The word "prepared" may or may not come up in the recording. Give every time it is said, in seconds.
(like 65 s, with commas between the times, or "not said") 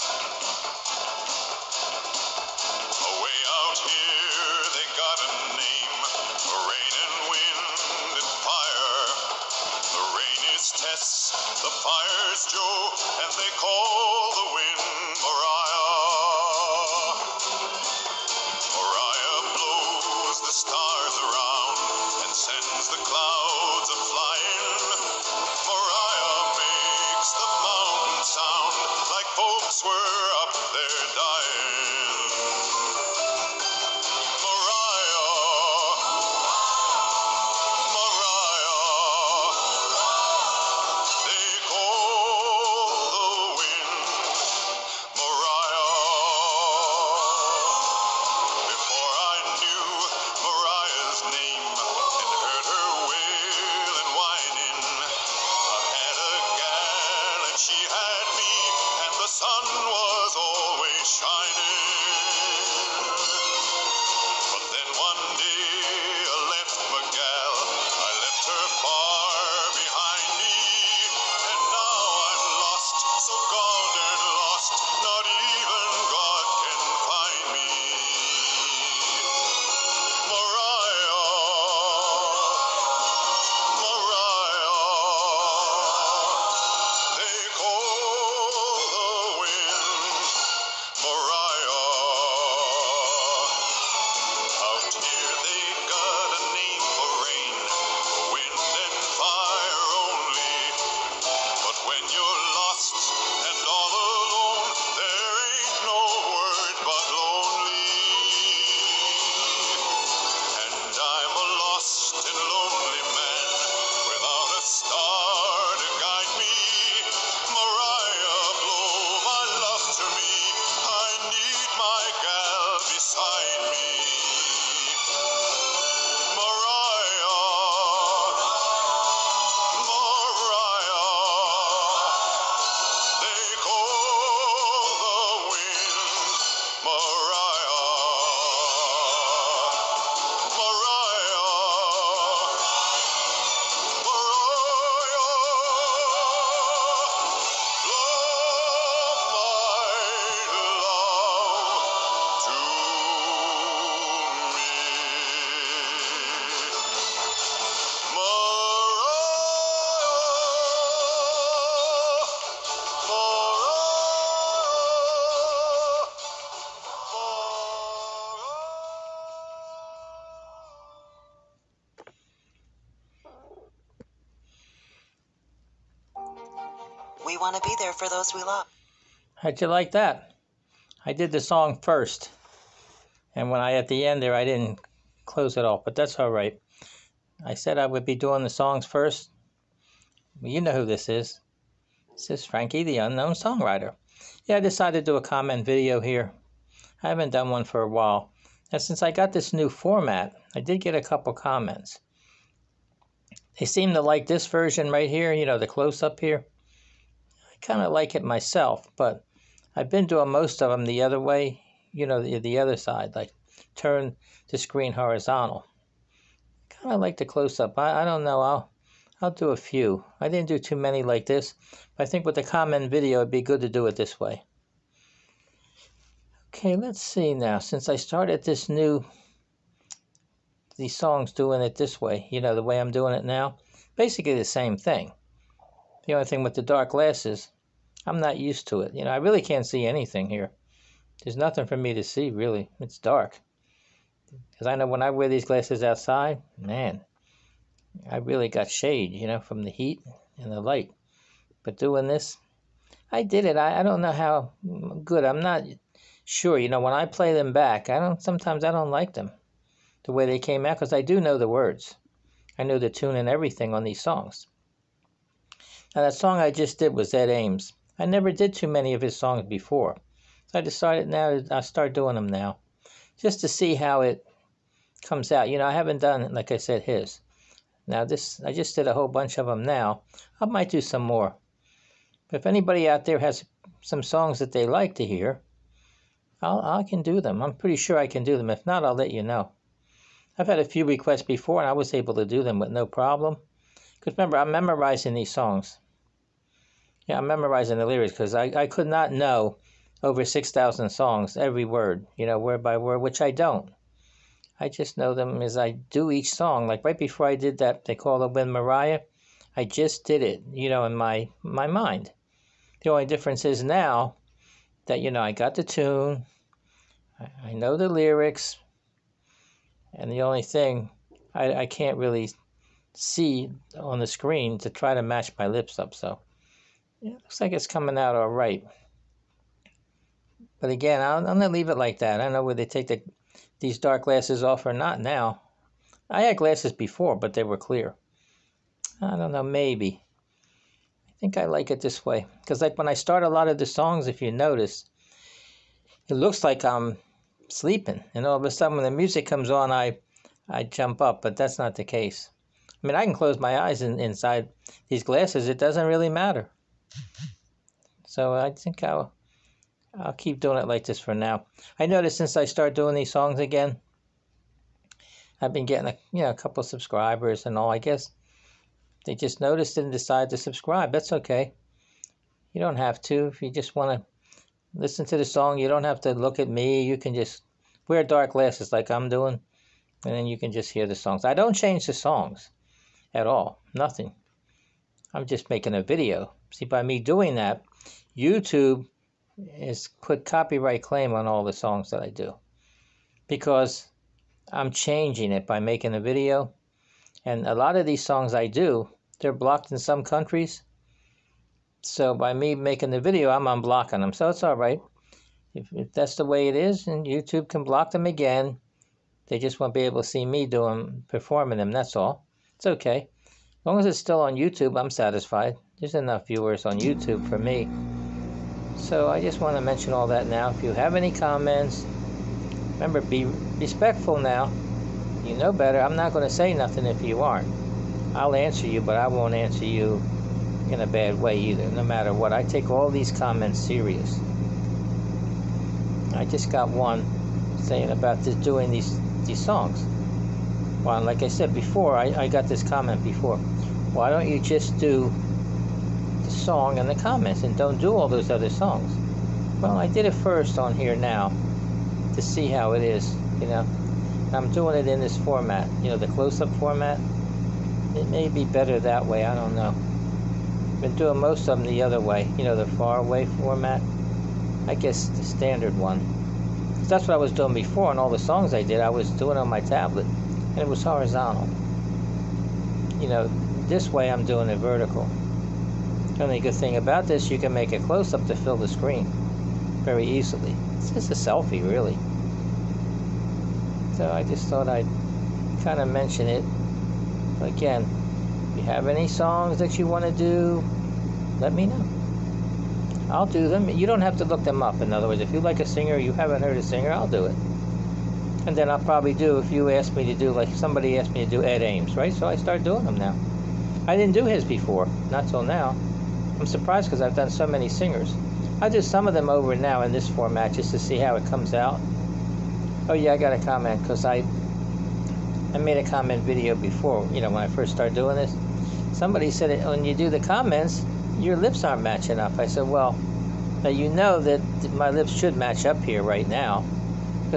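not said.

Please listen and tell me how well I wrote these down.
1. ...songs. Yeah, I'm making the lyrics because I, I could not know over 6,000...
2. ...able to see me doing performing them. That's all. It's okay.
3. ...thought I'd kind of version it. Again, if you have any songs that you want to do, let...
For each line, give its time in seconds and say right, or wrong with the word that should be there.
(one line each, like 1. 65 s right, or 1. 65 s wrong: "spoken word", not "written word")
1. 295 s wrong: "memorizing", not "making"
2. 409 s right
3. 484 s wrong: "mention", not "version".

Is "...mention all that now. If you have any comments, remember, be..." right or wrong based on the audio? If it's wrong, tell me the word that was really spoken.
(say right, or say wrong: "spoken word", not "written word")
right.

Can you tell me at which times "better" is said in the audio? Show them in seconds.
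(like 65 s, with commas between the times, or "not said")
425 s, 458 s.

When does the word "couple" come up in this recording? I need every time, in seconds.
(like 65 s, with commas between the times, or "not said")
201 s, 366 s.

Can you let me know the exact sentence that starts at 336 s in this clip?
I had glasses before, but they were clear.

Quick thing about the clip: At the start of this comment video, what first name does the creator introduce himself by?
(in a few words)
Frankie.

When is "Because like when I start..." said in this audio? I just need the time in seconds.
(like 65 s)
342 s.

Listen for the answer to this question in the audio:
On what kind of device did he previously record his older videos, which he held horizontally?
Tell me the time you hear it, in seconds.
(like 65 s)
469 s.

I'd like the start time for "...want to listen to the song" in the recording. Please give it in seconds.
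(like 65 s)
373 s.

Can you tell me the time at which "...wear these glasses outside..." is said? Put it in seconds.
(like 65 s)
245 s.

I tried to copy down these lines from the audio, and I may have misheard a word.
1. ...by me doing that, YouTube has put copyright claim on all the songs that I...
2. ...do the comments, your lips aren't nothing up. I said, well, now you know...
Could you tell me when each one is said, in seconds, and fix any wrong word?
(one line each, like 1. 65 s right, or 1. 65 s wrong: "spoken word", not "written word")
1. 386 s right
2. 519 s wrong: "matching", not "nothing".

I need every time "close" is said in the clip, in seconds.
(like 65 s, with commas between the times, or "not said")
185 s, 205 s, 217 s, 353 s, 456 s, 477 s.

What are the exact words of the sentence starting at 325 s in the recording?
So yeah, looks like it's coming out all right.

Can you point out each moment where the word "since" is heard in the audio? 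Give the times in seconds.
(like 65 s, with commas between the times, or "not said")
198 s, 227 s, 362 s.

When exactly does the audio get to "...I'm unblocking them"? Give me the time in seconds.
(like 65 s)
403 s.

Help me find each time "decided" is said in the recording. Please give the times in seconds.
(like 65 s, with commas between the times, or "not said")
194 s, 270 s, 369 s.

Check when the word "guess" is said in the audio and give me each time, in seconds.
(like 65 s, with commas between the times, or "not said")
367 s, 464 s.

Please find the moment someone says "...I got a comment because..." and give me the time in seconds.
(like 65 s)
513 s.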